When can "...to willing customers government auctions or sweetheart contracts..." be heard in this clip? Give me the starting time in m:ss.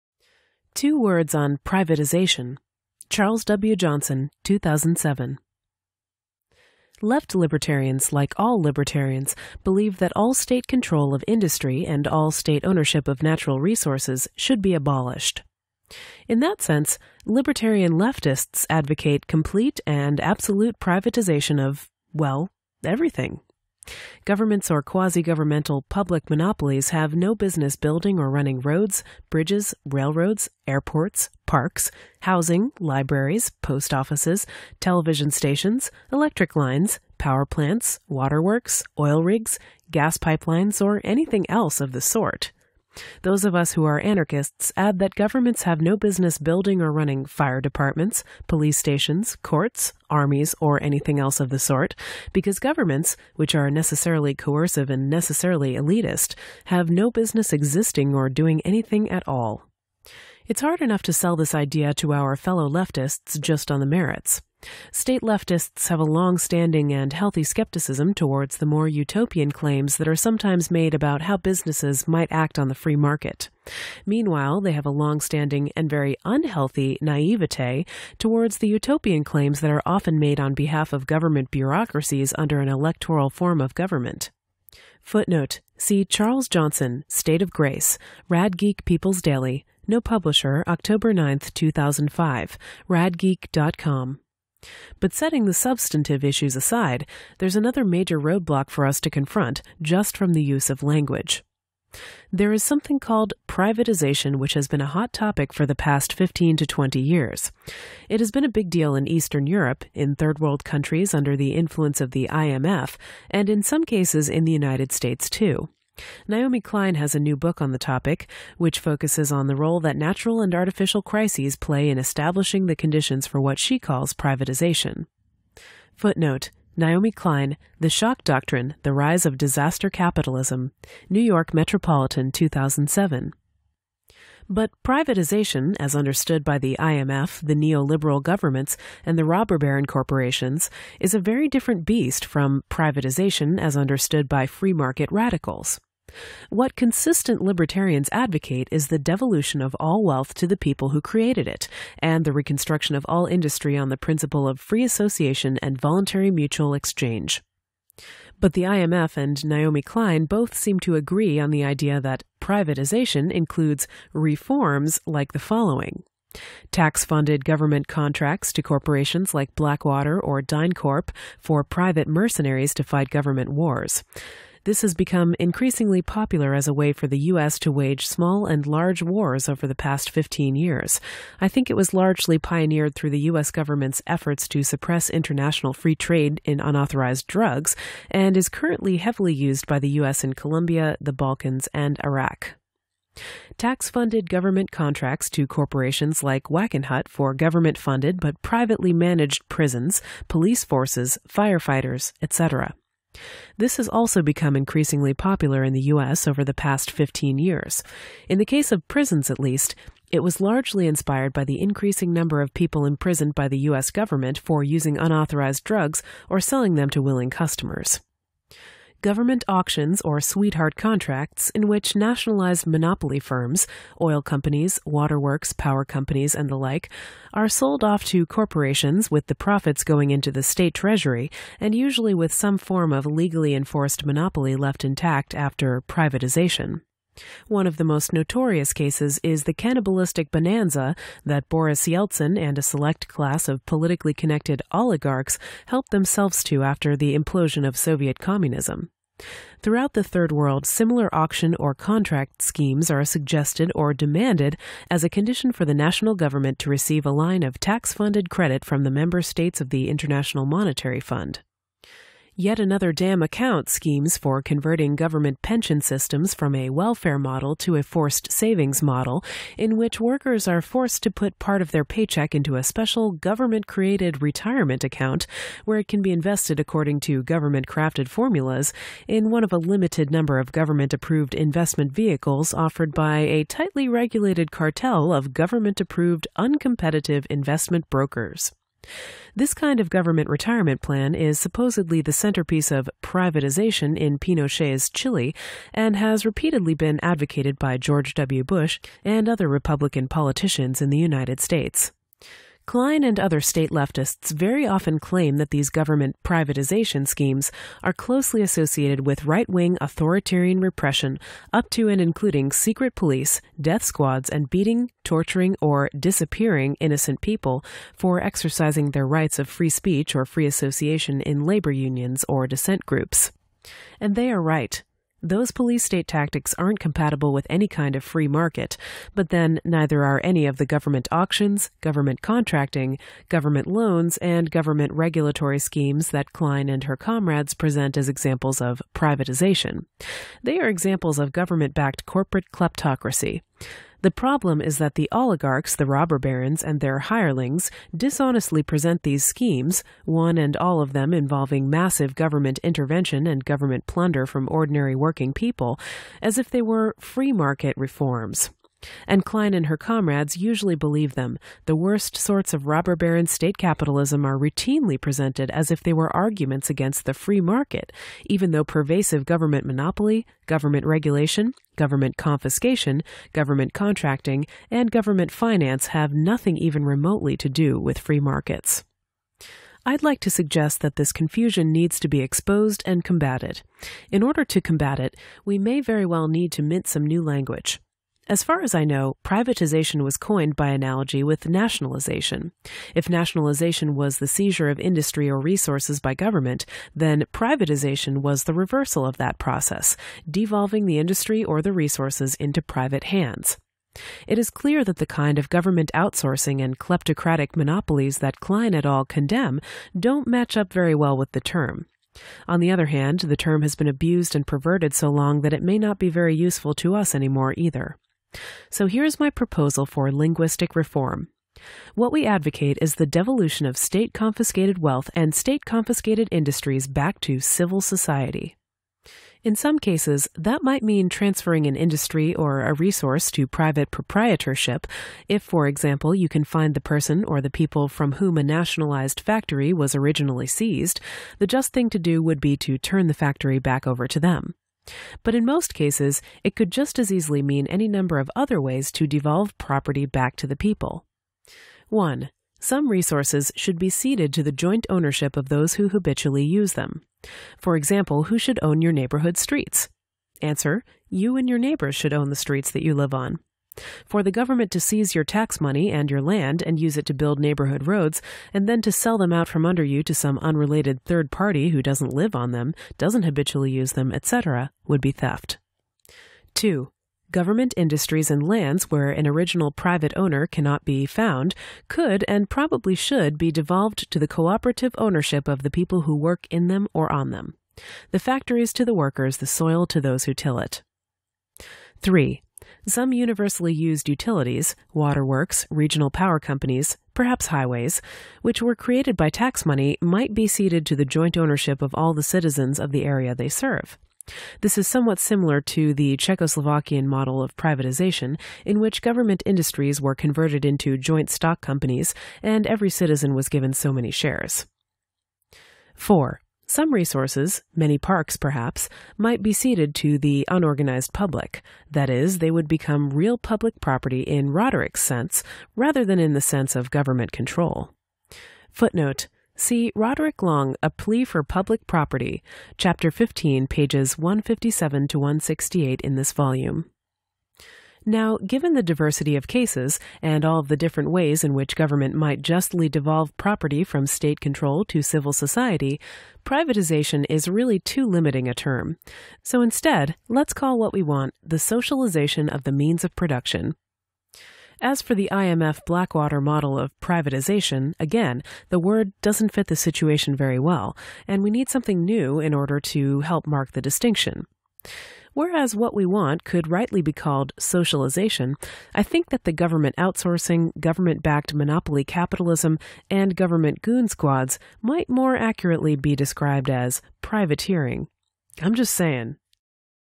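3:36.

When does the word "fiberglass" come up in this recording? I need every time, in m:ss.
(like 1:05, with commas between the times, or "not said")
not said.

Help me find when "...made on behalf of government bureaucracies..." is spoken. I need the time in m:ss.
1:20.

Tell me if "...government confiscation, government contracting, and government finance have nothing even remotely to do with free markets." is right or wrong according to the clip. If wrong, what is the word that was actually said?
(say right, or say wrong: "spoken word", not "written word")
right.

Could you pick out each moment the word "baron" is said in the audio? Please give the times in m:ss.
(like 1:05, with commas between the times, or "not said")
2:19, 5:46, 6:02.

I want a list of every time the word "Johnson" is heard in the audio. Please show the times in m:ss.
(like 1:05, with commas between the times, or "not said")
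0:03, 1:26.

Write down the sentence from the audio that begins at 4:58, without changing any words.
Bush and other Republican politicians in the United States.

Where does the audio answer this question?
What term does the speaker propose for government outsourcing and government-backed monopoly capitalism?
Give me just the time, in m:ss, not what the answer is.
9:37.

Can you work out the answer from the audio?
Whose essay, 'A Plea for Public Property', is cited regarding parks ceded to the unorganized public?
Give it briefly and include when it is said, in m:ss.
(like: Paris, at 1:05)
Roderick Long, at 8:49.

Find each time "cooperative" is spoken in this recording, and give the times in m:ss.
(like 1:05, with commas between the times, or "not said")
8:04.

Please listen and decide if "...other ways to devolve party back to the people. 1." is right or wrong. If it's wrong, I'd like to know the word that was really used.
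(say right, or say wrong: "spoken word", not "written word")
wrong: "property", not "party".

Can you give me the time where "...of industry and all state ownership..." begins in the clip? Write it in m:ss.
0:11.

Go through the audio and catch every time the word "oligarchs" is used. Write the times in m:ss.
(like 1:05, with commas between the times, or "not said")
4:04, 5:45.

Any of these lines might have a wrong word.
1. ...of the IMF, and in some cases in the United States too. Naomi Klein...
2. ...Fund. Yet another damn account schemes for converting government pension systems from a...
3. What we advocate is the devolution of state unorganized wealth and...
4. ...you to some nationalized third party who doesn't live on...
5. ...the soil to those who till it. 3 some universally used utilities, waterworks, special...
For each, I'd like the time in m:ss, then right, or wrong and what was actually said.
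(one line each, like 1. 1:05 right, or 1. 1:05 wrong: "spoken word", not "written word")
1. 1:51 right
2. 4:20 right
3. 7:01 wrong: "confiscated", not "unorganized"
4. 7:49 wrong: "unrelated", not "nationalized"
5. 8:09 wrong: "regional", not "special".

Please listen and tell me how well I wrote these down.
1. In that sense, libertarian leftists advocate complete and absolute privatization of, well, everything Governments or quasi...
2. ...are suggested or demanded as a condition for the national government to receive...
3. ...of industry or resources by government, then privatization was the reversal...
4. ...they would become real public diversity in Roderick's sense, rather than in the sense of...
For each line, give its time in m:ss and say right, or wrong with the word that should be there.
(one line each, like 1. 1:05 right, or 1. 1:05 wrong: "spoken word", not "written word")
1. 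0:16 right
2. 4:12 right
3. 6:34 right
4. 8:42 wrong: "property", not "diversity".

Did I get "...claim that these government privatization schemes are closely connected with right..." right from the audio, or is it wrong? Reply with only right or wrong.
wrong.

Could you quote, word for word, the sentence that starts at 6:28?
As far as I know, privatization was coined by analogy with nationalization.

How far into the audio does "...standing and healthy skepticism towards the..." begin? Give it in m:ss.
1:06.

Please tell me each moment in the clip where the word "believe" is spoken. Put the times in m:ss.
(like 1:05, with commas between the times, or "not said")
0:09, 6:00.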